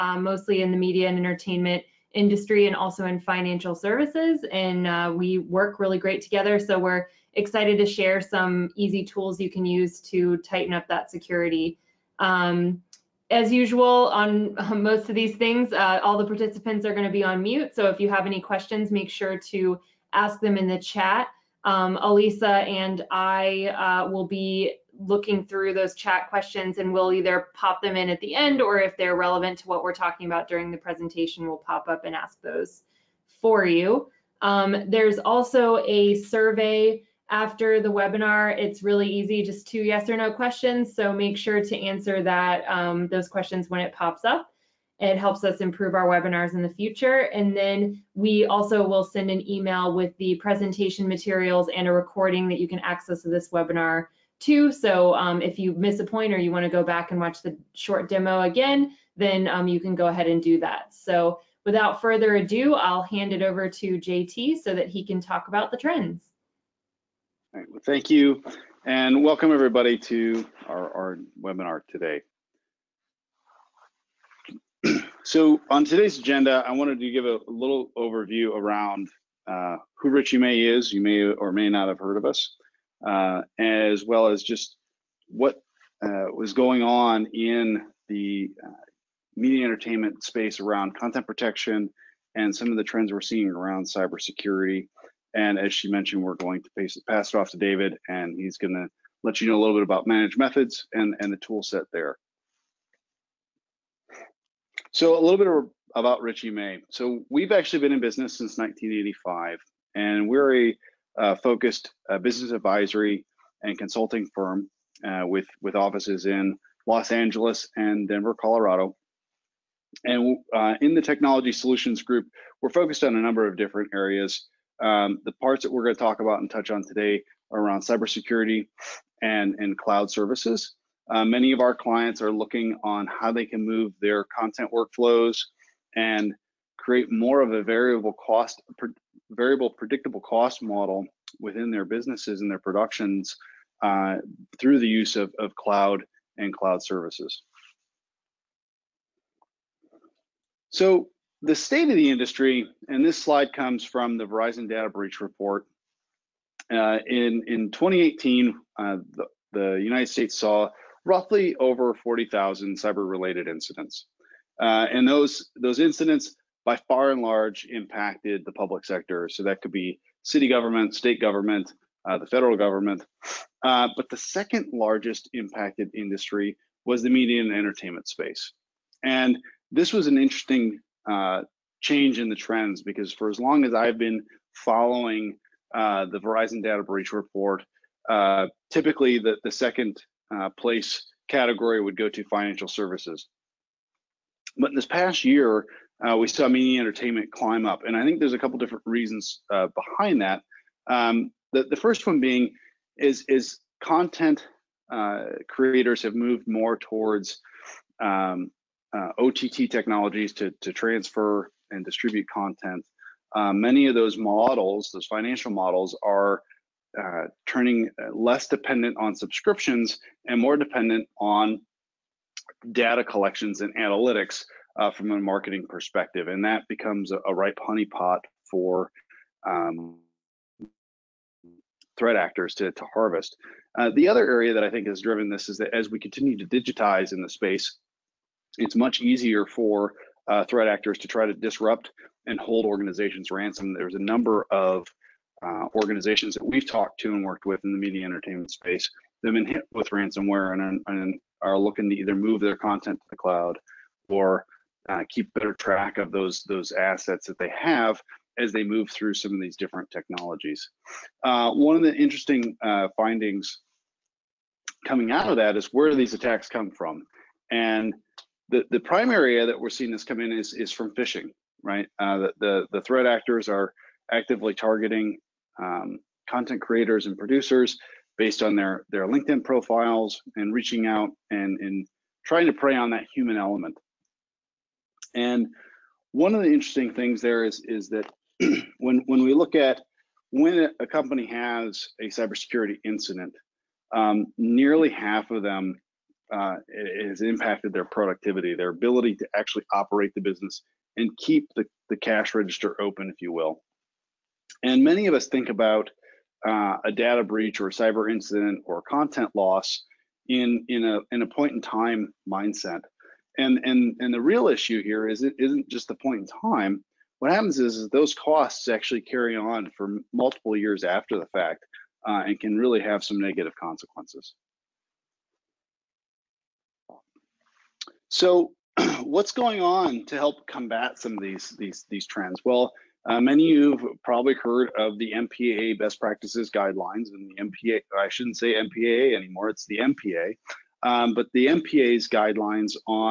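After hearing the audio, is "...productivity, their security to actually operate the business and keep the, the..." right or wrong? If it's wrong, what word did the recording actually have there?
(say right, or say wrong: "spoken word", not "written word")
wrong: "ability", not "security".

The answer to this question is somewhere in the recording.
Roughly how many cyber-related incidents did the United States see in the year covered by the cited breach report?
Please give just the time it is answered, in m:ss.
2:41.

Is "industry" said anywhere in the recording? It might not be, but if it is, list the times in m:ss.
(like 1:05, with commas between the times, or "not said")
0:02, 2:32, 2:55.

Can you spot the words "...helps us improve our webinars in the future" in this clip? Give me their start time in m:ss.
0:45.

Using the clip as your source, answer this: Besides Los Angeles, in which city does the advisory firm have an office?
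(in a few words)
Denver.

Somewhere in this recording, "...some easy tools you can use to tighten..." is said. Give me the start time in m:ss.
0:08.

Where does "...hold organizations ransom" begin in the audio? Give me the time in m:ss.
4:02.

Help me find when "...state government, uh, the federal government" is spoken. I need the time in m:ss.
2:50.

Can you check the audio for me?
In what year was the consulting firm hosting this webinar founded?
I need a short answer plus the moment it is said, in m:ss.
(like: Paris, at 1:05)
1985, at 1:48.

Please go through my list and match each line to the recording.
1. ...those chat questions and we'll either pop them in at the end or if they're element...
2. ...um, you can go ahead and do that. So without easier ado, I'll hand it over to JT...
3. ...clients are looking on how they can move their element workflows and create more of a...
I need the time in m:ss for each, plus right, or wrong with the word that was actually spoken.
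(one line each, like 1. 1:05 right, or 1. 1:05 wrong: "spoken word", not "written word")
1. 0:25 wrong: "relevant", not "element"
2. 0:59 wrong: "further", not "easier"
3. 2:11 wrong: "content", not "element".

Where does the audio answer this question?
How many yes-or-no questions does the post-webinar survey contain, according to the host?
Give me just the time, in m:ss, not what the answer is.
0:39.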